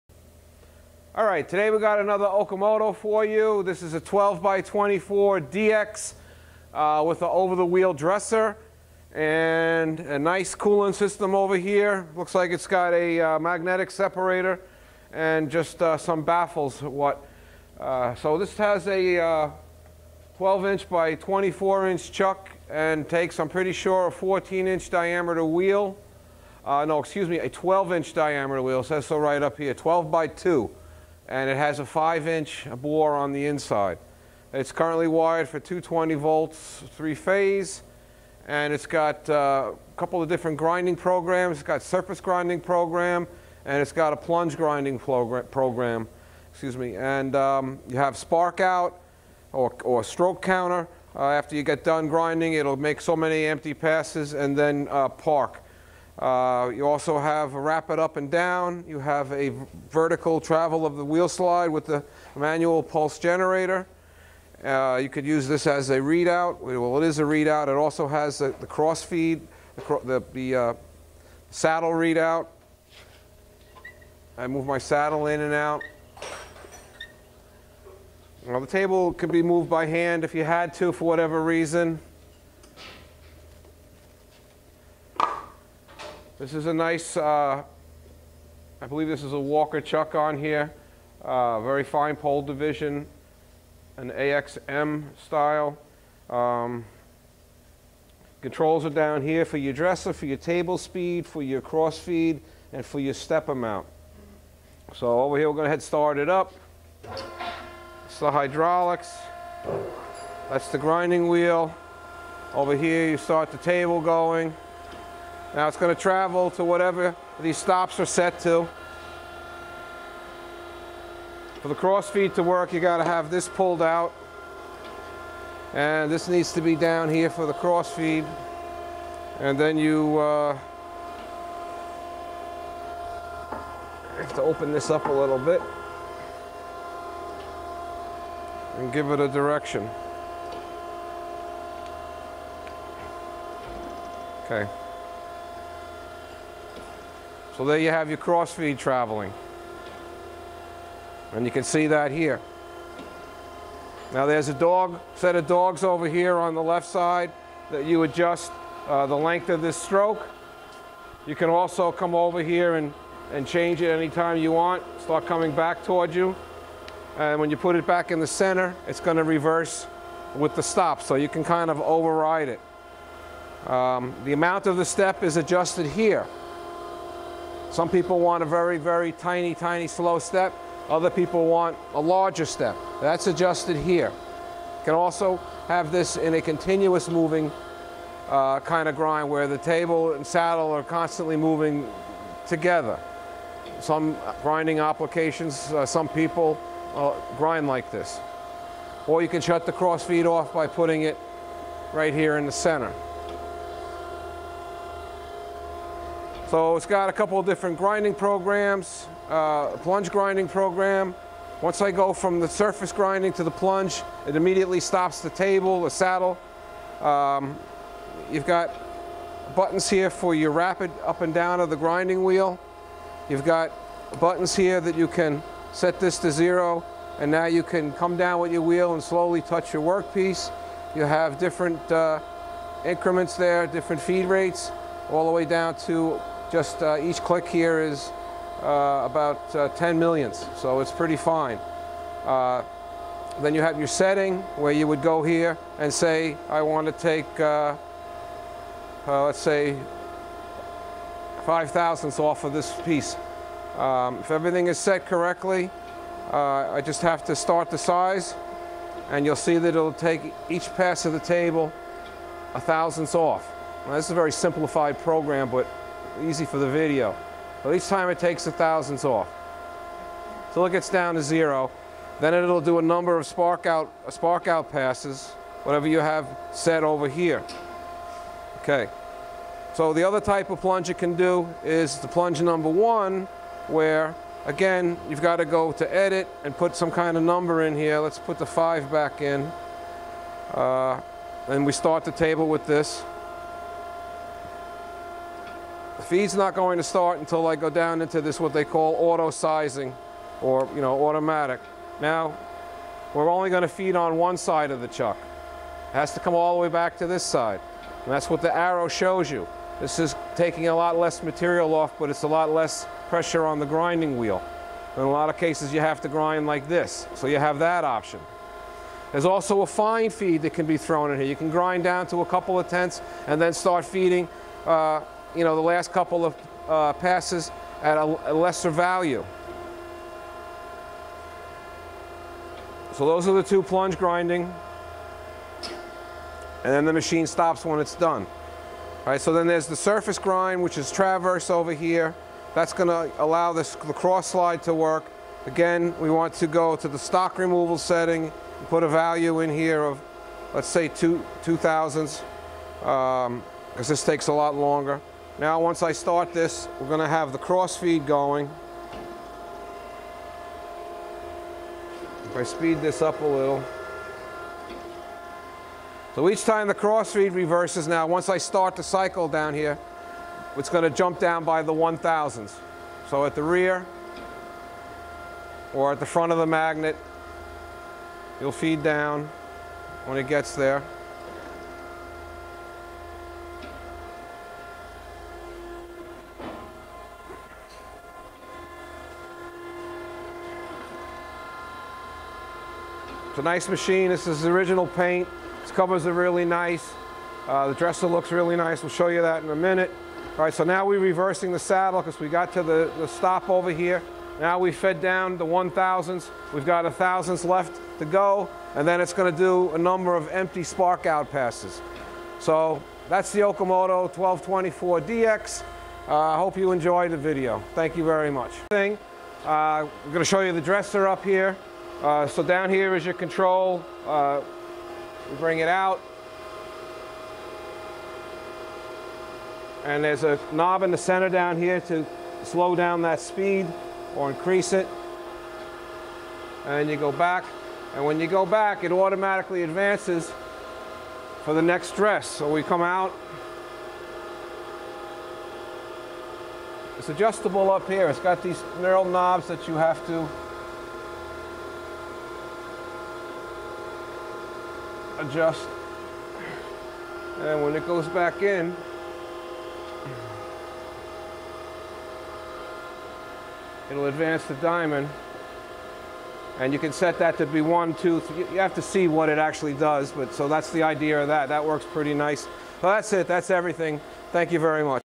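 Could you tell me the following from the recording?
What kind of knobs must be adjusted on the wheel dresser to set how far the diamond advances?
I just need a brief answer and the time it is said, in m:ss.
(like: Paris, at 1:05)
knurl knobs, at 7:28.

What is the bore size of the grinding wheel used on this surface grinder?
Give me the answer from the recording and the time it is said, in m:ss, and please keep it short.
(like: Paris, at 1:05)
5 inches, at 0:31.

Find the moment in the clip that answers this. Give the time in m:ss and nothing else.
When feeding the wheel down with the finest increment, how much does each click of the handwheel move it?
3:59.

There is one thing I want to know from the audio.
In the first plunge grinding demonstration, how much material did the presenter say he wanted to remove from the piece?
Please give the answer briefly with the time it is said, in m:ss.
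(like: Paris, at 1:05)
5 thousandths, at 4:11.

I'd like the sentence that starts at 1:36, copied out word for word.
Um, controls are down here for your dresser, for your table speed, for your cross feed, and for your step amount.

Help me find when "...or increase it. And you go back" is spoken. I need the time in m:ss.
7:14.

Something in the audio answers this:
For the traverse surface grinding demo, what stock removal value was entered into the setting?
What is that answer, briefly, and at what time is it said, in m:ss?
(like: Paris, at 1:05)
2 thousandths, at 5:51.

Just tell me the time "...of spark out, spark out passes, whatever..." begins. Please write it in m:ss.
4:33.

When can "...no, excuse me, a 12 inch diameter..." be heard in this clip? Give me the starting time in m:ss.
0:26.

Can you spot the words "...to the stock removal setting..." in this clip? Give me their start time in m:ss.
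5:46.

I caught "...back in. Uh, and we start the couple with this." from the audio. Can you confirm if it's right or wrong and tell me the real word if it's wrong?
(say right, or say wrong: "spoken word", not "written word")
wrong: "table", not "couple".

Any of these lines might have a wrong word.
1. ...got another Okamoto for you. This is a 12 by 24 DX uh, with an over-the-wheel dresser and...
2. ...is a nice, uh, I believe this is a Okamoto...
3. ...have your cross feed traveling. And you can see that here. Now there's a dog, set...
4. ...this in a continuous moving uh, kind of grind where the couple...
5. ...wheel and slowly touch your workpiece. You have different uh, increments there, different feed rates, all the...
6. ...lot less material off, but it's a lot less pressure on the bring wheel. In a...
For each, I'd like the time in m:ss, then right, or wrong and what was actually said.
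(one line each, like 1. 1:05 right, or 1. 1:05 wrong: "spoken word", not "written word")
1. 0:01 right
2. 1:26 wrong: "Walker", not "Okamoto"
3. 2:27 right
4. 3:05 wrong: "table", not "couple"
5. 3:48 right
6. 5:10 wrong: "grinding", not "bring".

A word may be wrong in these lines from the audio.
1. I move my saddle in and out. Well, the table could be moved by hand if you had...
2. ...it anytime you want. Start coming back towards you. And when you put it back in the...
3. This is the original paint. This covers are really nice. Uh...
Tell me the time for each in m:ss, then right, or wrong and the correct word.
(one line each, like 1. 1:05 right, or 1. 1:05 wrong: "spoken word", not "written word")
1. 1:14 right
2. 2:43 right
3. 6:34 right.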